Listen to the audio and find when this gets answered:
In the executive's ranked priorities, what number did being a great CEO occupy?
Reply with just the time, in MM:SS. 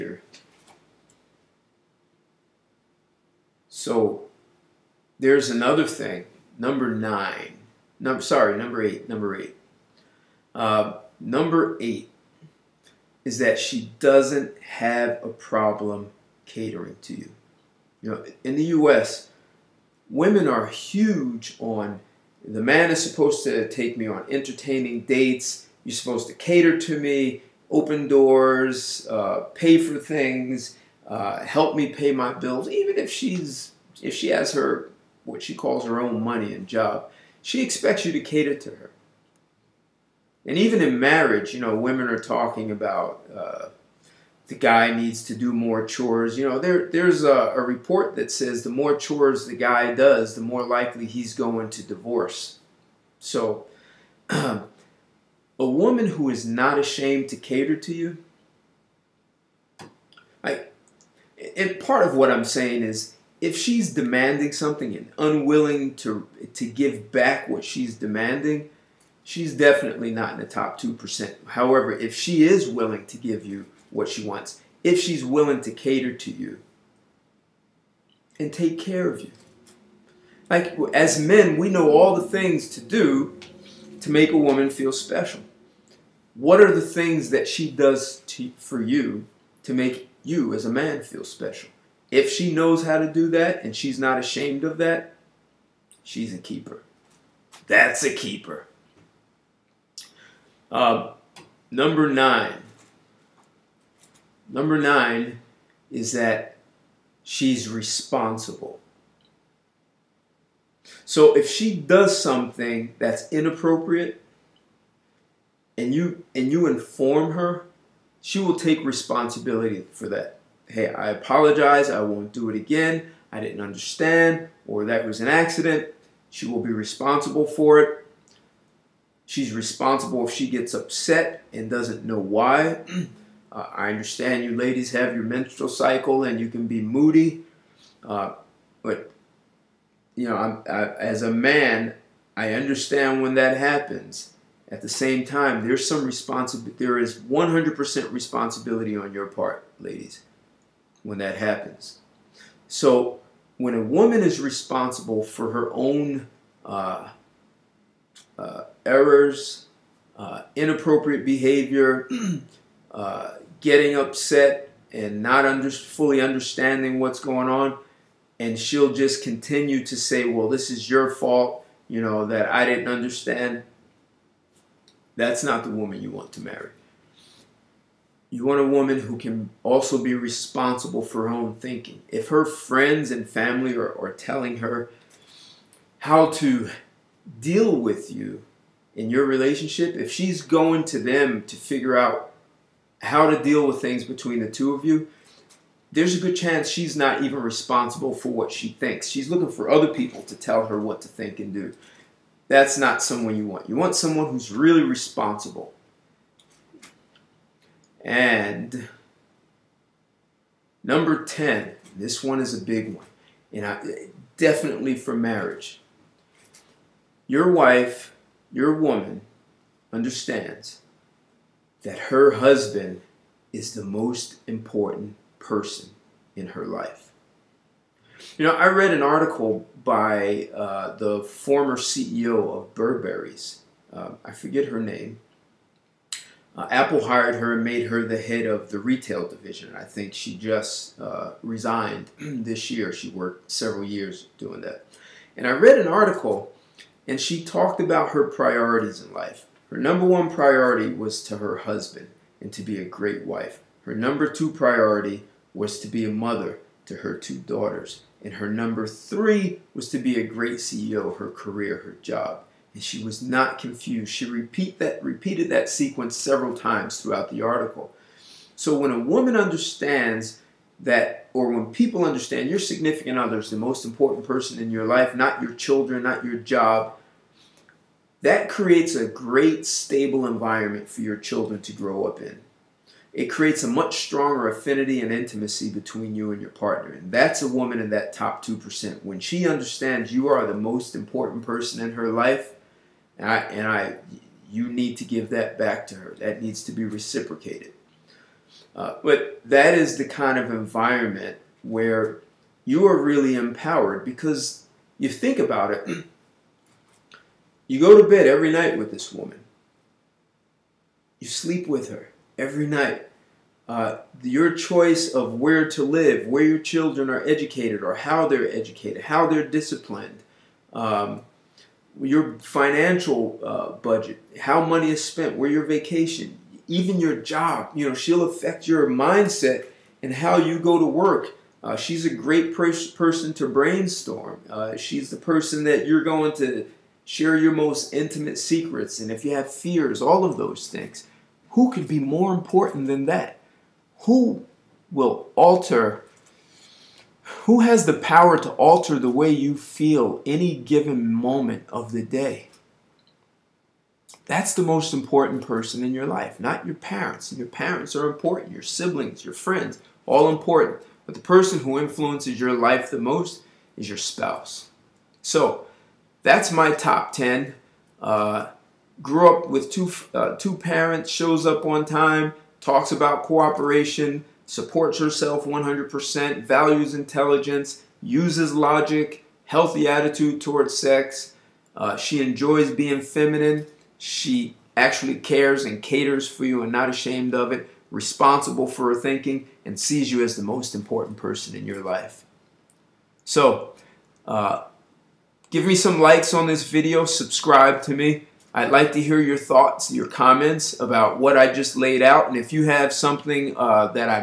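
04:18.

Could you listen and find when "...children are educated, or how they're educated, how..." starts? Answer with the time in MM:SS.
05:16.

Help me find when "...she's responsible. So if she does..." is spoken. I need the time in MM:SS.
01:47.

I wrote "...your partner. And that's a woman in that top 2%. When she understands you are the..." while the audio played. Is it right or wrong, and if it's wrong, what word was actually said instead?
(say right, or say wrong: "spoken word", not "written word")
right.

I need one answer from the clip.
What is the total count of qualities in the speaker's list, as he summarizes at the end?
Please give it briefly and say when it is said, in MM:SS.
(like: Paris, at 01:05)
10, at 06:06.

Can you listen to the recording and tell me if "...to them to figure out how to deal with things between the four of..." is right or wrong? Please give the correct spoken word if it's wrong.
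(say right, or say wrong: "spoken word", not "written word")
wrong: "two", not "four".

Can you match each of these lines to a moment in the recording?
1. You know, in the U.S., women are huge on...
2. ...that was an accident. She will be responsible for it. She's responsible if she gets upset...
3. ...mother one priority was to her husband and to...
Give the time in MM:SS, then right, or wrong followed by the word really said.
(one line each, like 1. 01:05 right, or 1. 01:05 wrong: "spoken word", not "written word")
1. 00:18 right
2. 02:04 right
3. 04:09 wrong: "number", not "mother".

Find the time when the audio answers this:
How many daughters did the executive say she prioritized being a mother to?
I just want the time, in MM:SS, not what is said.
04:17.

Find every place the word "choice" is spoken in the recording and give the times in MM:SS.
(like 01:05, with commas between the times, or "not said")
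05:14.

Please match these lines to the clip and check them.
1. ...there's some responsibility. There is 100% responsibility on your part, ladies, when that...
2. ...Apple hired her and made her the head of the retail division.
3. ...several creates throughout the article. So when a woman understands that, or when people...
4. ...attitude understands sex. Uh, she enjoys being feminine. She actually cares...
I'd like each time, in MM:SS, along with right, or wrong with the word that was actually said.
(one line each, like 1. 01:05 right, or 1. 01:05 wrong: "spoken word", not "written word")
1. 02:25 right
2. 03:56 right
3. 04:26 wrong: "times", not "creates"
4. 06:19 wrong: "towards", not "understands".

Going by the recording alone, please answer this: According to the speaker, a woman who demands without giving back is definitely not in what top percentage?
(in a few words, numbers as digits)
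2%.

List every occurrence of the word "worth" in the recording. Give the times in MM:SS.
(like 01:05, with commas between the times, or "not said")
not said.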